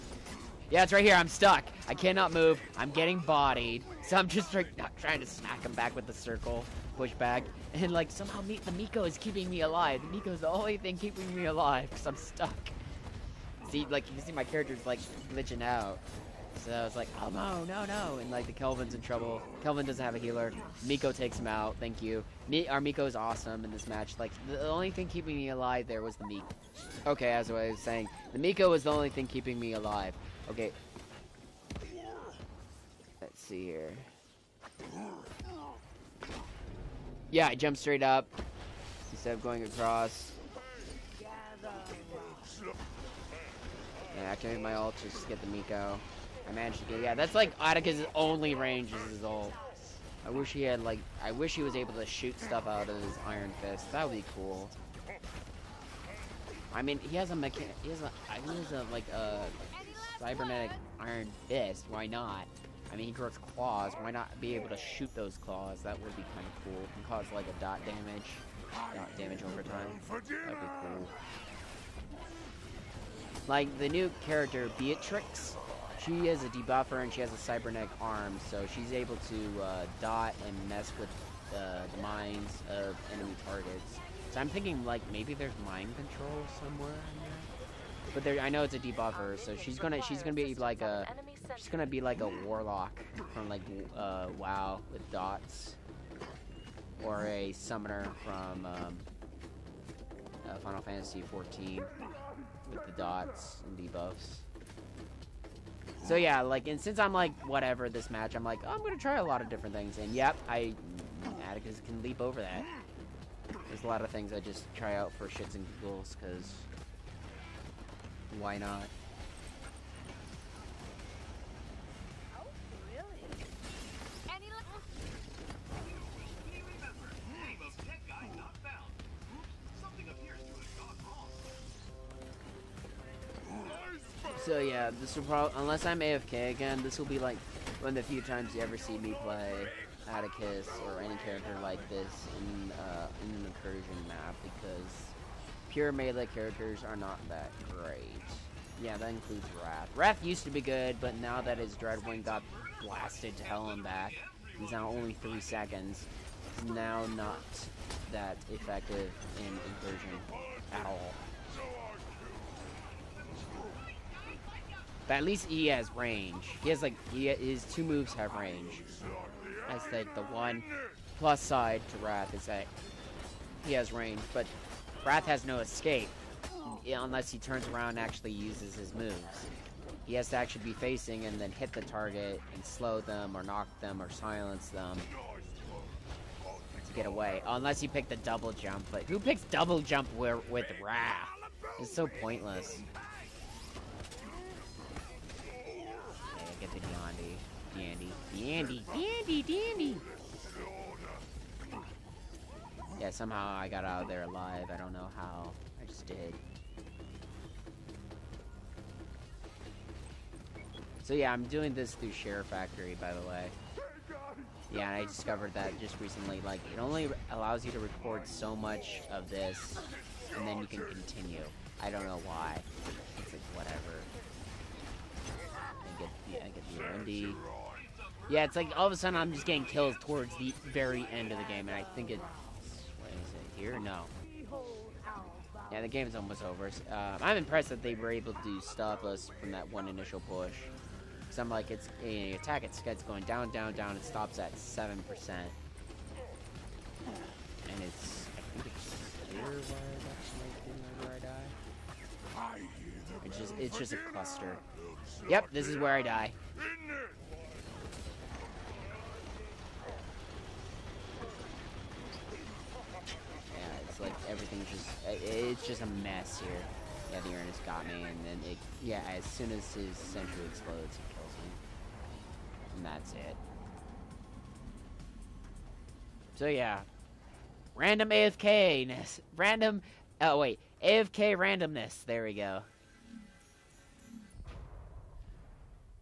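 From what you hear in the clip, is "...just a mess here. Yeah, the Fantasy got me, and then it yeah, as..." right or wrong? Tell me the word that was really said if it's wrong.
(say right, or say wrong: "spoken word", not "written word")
wrong: "Ernest", not "Fantasy".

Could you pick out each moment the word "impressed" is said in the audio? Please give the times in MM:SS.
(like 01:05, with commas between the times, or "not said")
03:57.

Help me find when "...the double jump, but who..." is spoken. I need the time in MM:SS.
03:08.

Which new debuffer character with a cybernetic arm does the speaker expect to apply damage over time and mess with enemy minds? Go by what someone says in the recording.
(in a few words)
Beatrix.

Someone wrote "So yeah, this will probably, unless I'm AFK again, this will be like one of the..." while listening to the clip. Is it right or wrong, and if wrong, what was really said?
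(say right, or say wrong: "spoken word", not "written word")
right.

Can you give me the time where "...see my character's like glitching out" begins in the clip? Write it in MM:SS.
00:14.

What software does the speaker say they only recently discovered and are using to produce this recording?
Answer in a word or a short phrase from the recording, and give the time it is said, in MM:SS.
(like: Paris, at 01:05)
SHAREfactory, at 03:32.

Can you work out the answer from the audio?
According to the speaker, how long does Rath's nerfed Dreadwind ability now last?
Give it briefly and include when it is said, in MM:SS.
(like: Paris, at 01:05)
3 seconds, at 02:35.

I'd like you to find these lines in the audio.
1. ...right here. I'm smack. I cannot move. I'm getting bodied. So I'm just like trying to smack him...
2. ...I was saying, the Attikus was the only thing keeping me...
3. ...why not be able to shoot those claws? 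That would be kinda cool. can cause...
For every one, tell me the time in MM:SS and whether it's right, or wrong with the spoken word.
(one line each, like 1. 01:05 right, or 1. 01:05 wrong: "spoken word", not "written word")
1. 00:00 wrong: "stuck", not "smack"
2. 00:27 wrong: "Miko", not "Attikus"
3. 01:03 right.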